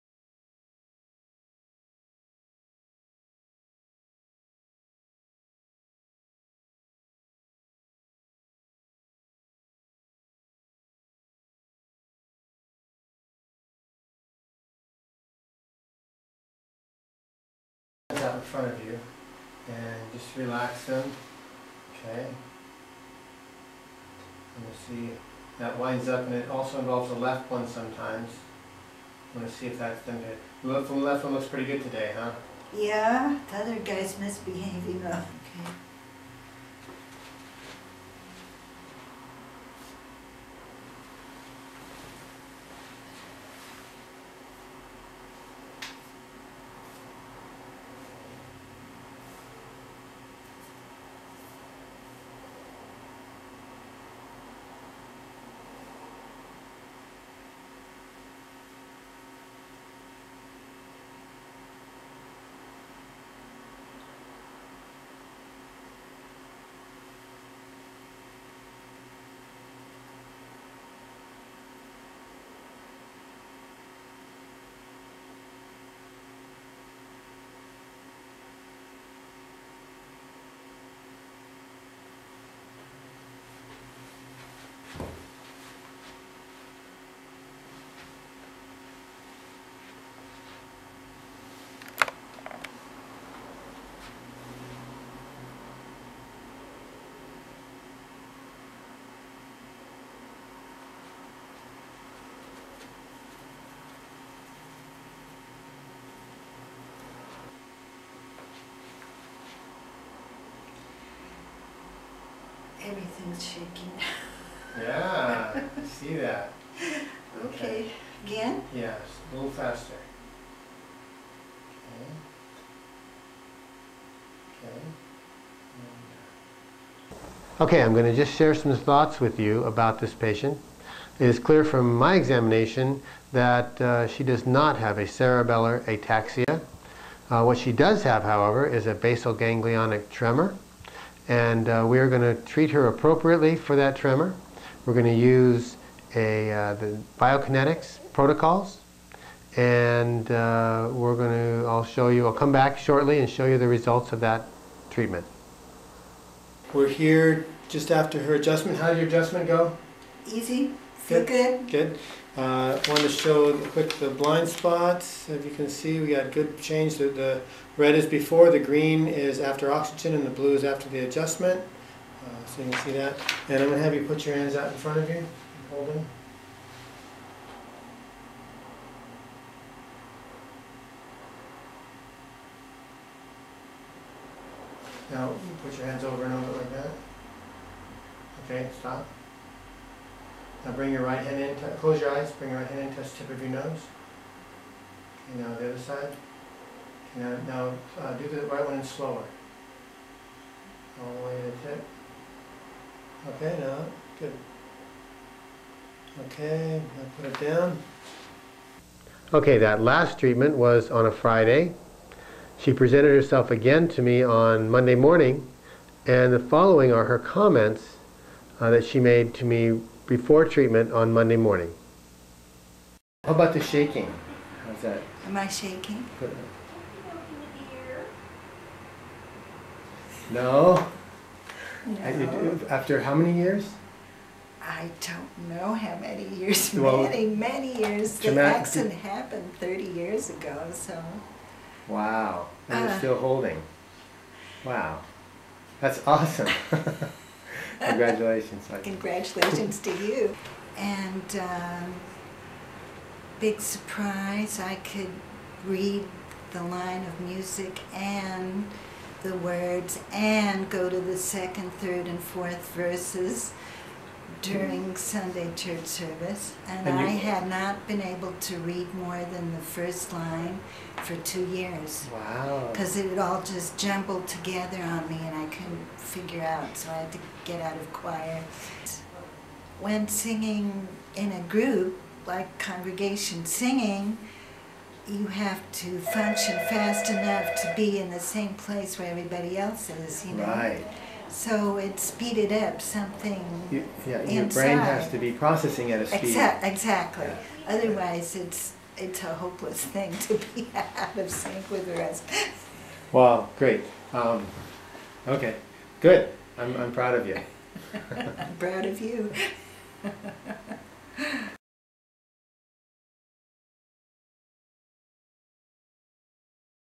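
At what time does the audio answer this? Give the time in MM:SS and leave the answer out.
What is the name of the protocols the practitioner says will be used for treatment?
02:27.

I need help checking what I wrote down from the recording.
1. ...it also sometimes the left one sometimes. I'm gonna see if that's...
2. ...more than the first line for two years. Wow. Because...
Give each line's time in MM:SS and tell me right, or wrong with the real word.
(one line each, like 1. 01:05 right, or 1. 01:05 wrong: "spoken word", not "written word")
1. 00:26 wrong: "involves", not "sometimes"
2. 04:28 right.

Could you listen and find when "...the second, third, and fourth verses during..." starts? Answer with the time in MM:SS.
04:20.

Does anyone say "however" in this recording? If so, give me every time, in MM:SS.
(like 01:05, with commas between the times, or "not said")
02:18.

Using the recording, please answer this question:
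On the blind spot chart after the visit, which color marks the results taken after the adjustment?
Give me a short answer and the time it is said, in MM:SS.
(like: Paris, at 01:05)
blue, at 02:50.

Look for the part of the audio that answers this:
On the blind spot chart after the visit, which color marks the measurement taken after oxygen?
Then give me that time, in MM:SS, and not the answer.
02:48.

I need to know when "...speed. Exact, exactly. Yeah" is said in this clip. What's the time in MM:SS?
04:56.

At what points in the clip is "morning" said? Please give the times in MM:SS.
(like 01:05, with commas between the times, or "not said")
03:34, 03:41.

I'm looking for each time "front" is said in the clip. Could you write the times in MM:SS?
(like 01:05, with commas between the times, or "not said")
00:18, 02:54.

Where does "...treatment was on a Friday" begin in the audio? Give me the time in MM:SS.
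03:30.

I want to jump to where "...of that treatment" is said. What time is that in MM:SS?
02:34.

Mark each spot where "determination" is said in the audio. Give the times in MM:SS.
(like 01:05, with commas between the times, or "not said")
not said.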